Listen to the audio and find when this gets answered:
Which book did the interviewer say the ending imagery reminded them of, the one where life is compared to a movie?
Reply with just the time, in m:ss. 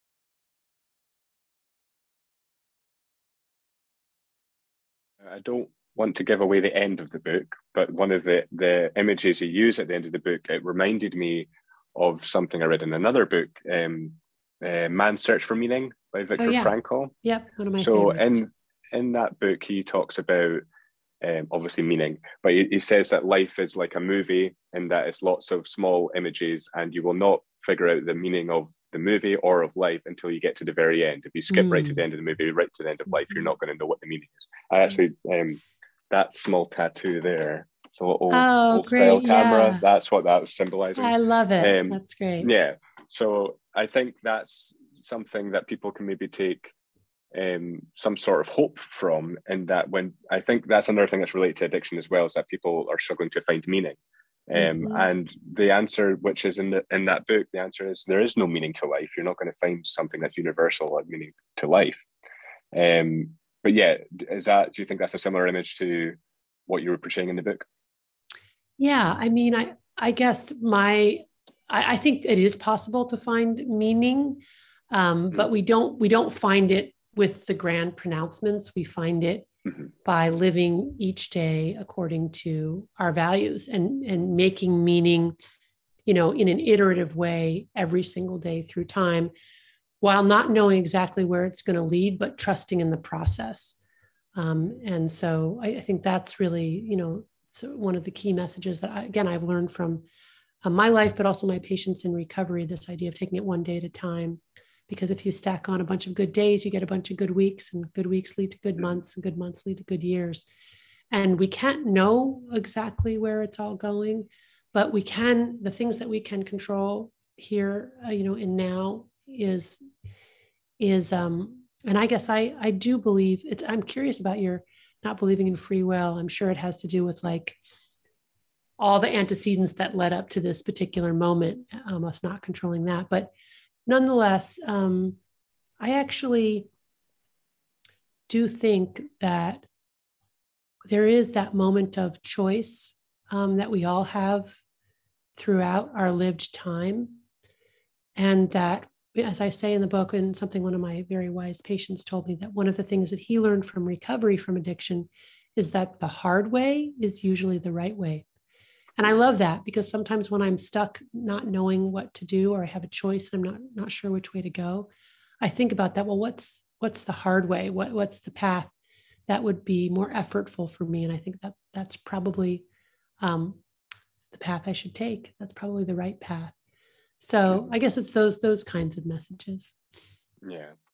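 0:14.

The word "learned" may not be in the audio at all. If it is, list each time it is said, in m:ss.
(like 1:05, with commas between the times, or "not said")
1:39, 2:33.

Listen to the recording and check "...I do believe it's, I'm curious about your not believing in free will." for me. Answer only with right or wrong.
right.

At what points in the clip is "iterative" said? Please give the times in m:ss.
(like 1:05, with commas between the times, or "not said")
1:26.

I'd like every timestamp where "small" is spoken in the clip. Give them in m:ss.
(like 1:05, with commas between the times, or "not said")
0:25, 0:36.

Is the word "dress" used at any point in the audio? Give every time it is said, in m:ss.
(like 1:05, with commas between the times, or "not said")
not said.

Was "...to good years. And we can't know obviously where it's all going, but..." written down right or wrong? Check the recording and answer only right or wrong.
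wrong.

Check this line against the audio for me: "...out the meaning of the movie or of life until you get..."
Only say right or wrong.
right.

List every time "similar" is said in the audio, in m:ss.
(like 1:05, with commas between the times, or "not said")
1:05.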